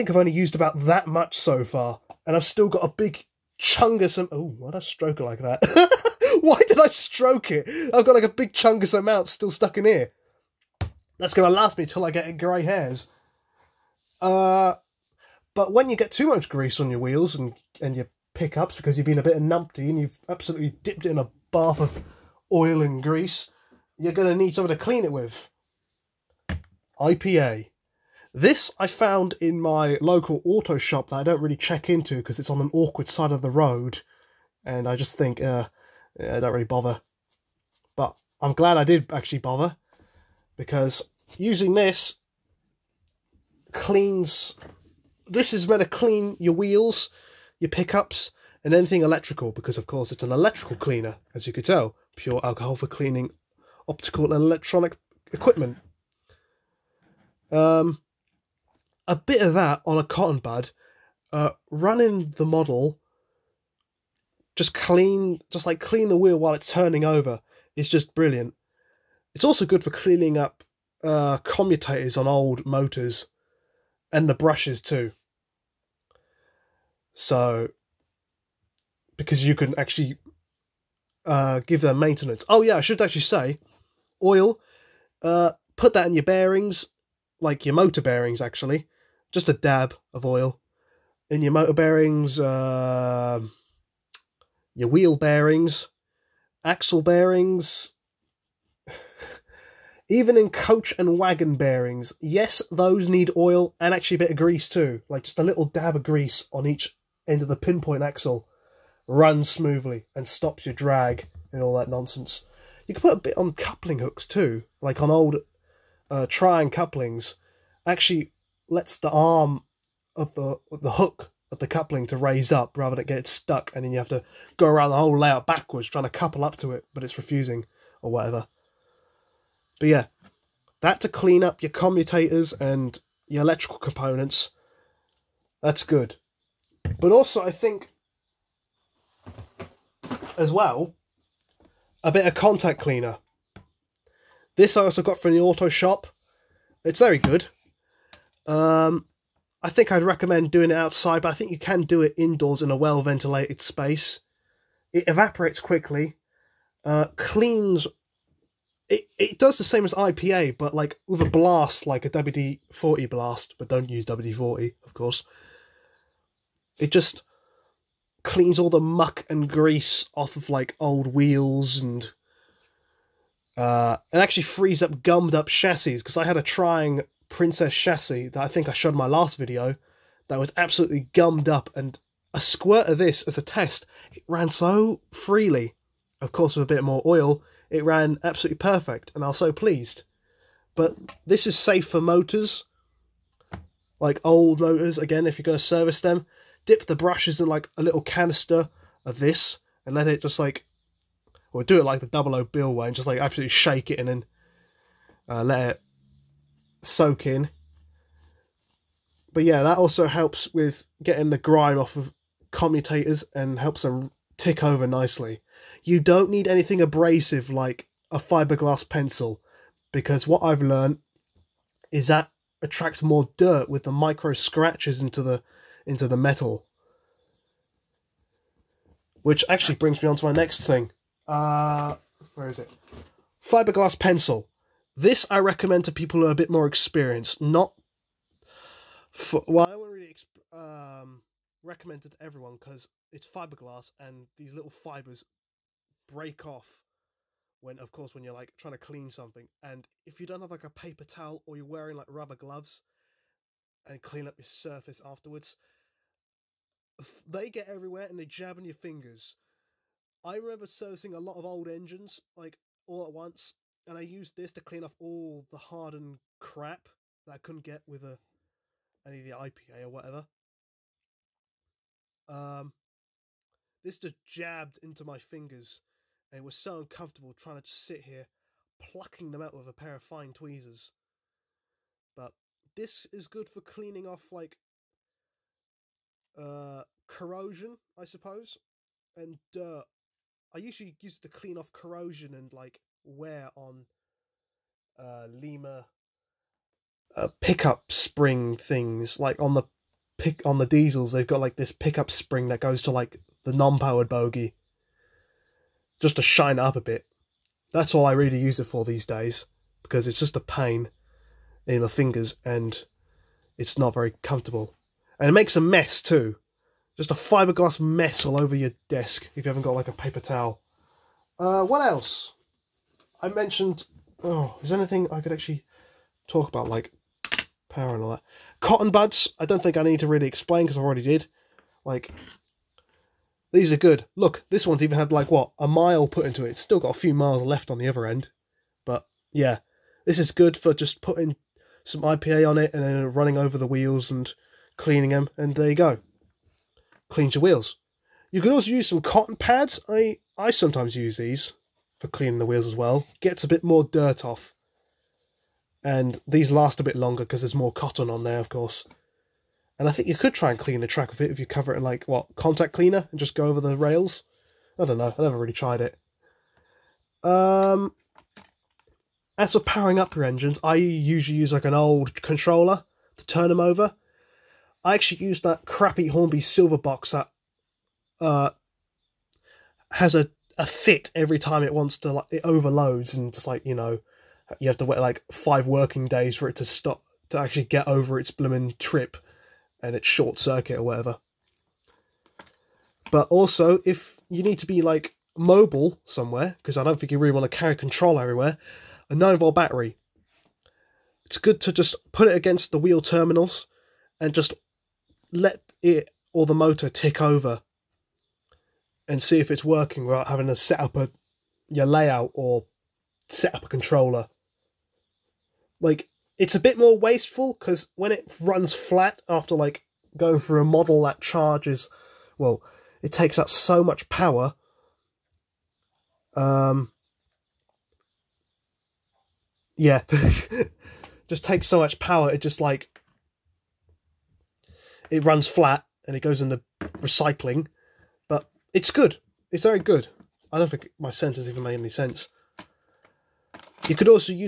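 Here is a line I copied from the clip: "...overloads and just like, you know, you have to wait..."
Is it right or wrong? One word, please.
right.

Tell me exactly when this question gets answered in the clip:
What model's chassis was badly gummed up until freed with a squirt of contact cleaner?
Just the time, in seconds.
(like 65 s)
176 s.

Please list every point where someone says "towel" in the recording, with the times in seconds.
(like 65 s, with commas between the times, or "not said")
251 s, 320 s.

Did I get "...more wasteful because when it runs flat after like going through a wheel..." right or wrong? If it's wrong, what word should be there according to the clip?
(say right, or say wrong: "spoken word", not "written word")
wrong: "model", not "wheel".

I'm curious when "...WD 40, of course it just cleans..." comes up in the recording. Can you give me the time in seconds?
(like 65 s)
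164 s.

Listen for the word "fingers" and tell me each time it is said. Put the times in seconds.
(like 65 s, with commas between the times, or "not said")
258 s, 275 s, 311 s.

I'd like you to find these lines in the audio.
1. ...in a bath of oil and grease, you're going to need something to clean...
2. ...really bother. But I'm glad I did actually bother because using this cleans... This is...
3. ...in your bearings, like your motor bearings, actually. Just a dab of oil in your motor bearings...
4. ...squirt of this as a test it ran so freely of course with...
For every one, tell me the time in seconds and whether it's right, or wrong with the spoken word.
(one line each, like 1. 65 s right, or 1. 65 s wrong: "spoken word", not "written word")
1. 21 s right
2. 36 s right
3. 86 s right
4. 182 s right.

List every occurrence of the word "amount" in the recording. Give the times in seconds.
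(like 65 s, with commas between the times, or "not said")
8 s.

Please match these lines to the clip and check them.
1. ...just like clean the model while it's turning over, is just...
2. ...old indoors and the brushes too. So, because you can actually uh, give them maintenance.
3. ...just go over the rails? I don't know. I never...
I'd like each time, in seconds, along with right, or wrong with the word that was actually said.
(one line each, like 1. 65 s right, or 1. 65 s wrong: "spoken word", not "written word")
1. 65 s wrong: "wheel", not "model"
2. 72 s wrong: "motors", not "indoors"
3. 363 s right.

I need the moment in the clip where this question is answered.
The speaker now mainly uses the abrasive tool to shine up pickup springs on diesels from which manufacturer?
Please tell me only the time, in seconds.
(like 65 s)
295 s.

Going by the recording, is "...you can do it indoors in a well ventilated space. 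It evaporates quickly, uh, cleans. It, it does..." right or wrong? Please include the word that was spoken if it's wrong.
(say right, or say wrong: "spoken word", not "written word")
right.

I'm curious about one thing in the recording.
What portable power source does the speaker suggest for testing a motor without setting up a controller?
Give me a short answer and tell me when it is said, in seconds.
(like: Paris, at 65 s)
9 volt battery, at 399 s.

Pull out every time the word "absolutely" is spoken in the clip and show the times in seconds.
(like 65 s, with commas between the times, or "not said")
20 s, 180 s, 188 s, 203 s.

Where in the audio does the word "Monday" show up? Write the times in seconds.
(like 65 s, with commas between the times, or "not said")
not said.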